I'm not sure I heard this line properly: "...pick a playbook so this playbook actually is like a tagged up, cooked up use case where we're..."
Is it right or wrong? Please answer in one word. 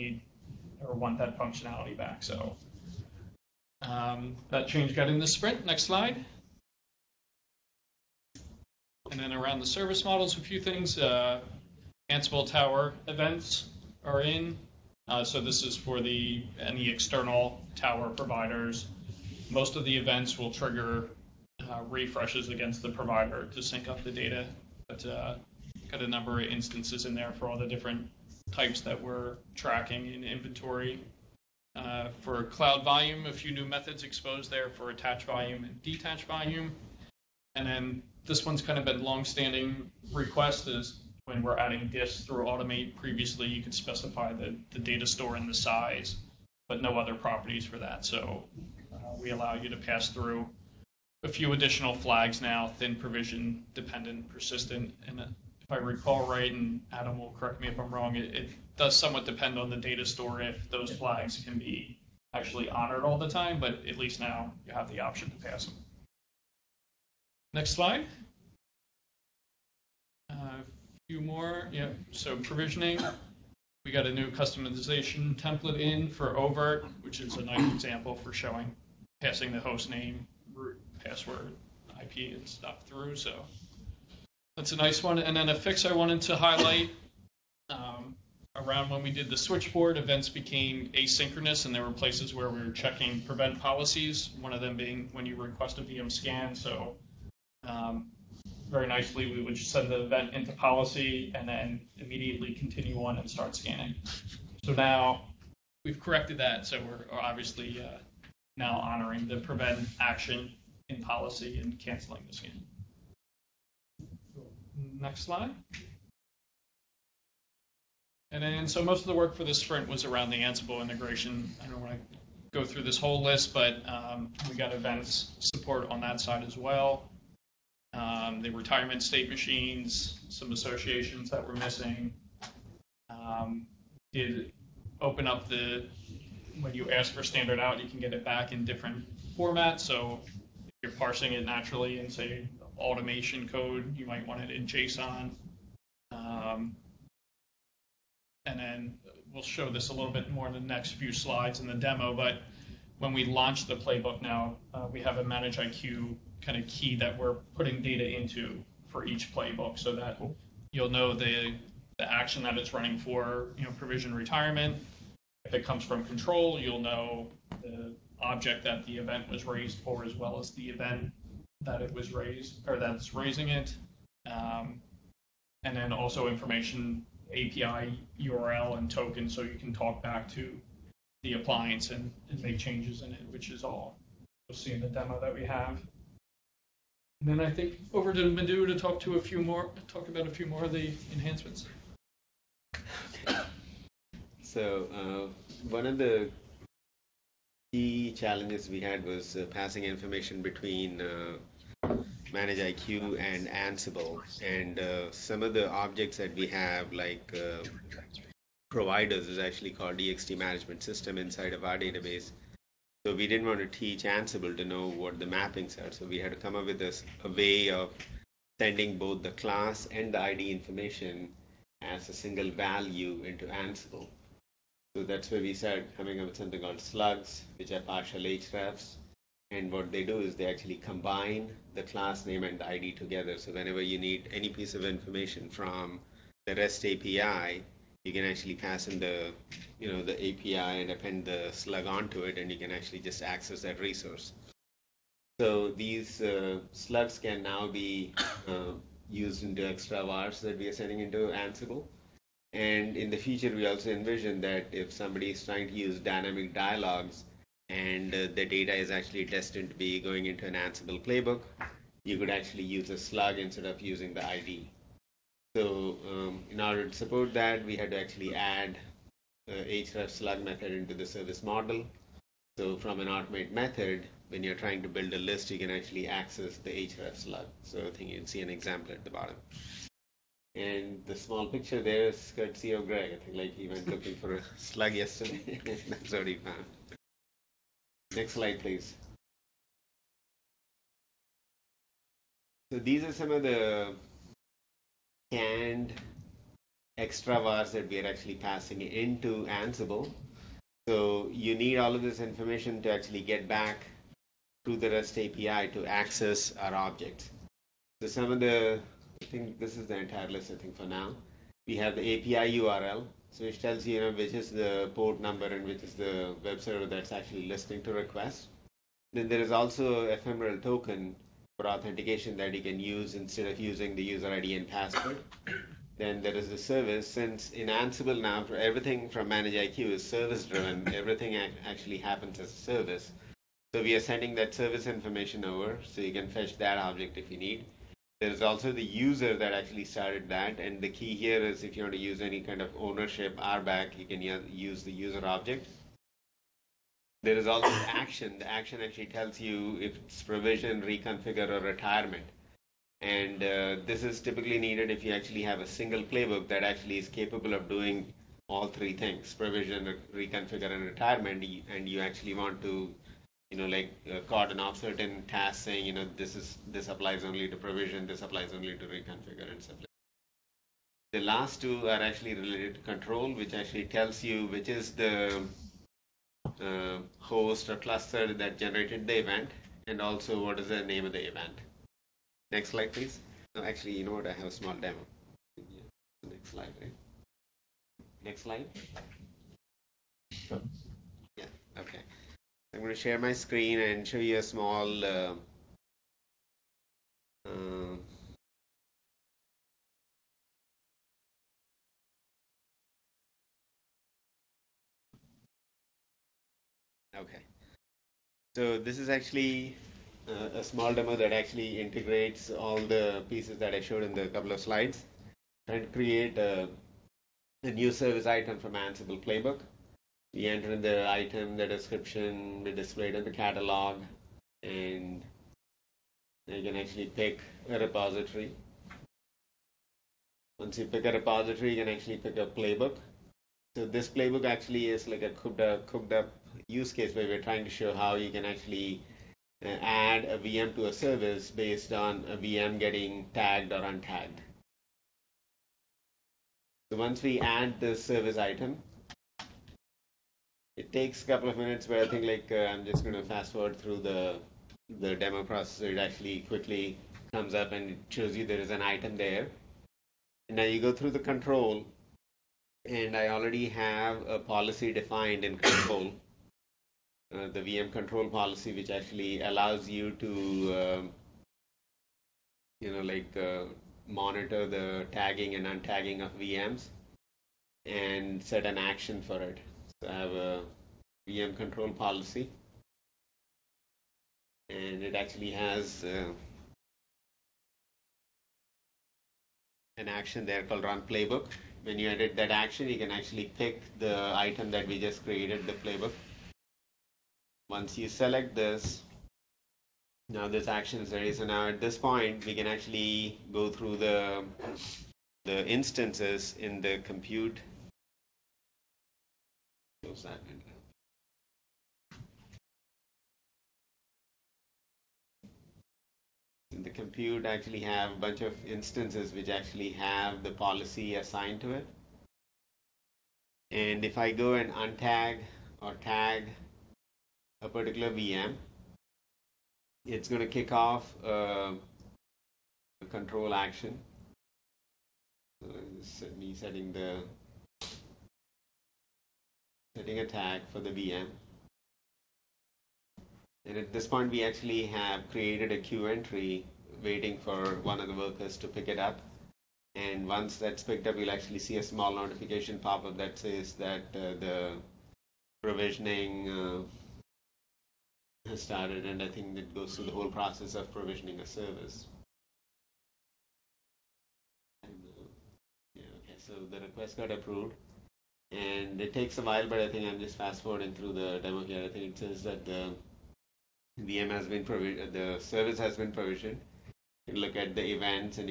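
wrong.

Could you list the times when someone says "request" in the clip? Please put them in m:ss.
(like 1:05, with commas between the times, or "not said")
0:40, 1:35, 5:17, 9:26.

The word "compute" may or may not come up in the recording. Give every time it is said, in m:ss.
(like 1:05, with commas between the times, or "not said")
8:26, 8:36.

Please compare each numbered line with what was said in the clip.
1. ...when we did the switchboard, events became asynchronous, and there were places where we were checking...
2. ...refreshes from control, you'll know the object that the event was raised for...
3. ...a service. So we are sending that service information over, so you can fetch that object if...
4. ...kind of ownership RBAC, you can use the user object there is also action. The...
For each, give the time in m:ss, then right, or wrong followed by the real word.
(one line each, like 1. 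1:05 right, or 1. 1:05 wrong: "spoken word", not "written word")
1. 1:28 right
2. 2:45 wrong: "comes", not "refreshes"
3. 5:32 right
4. 5:42 right.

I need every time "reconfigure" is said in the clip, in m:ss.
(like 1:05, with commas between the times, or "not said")
5:50, 6:00, 6:08.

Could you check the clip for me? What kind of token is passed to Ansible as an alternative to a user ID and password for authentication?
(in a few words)
ephemeral token.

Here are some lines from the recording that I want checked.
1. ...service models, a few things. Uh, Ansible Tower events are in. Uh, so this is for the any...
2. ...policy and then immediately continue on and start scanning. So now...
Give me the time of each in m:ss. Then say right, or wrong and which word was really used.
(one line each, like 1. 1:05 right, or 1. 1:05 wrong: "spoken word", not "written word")
1. 0:09 right
2. 1:40 right.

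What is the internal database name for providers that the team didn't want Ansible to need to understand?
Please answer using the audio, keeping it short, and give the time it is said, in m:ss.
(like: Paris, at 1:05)
ext management system, at 3:29.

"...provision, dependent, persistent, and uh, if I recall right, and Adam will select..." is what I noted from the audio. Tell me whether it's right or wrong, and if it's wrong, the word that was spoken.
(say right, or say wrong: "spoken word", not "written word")
wrong: "correct", not "select".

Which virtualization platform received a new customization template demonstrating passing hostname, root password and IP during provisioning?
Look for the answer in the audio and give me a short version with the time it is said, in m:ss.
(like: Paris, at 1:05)
oVirt, at 1:16.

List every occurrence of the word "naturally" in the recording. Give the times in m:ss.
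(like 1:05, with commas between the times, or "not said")
2:21.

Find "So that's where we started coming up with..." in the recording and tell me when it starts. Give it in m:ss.
3:44.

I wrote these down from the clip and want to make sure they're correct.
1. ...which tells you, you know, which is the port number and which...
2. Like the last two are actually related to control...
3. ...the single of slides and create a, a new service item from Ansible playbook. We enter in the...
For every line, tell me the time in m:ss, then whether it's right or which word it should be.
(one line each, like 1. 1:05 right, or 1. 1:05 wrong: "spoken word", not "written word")
1. 5:13 right
2. 6:09 right
3. 6:54 wrong: "couple", not "single".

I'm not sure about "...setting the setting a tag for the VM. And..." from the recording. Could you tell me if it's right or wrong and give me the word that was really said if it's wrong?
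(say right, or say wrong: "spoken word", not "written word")
right.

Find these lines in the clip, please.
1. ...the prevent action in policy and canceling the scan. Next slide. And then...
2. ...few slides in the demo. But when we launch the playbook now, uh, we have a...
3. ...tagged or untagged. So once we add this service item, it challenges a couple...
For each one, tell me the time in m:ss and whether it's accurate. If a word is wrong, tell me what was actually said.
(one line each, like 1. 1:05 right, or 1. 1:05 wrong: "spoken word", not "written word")
1. 1:49 right
2. 2:30 right
3. 7:23 wrong: "takes", not "challenges".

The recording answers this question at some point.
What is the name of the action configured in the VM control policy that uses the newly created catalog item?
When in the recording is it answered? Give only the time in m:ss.
8:10.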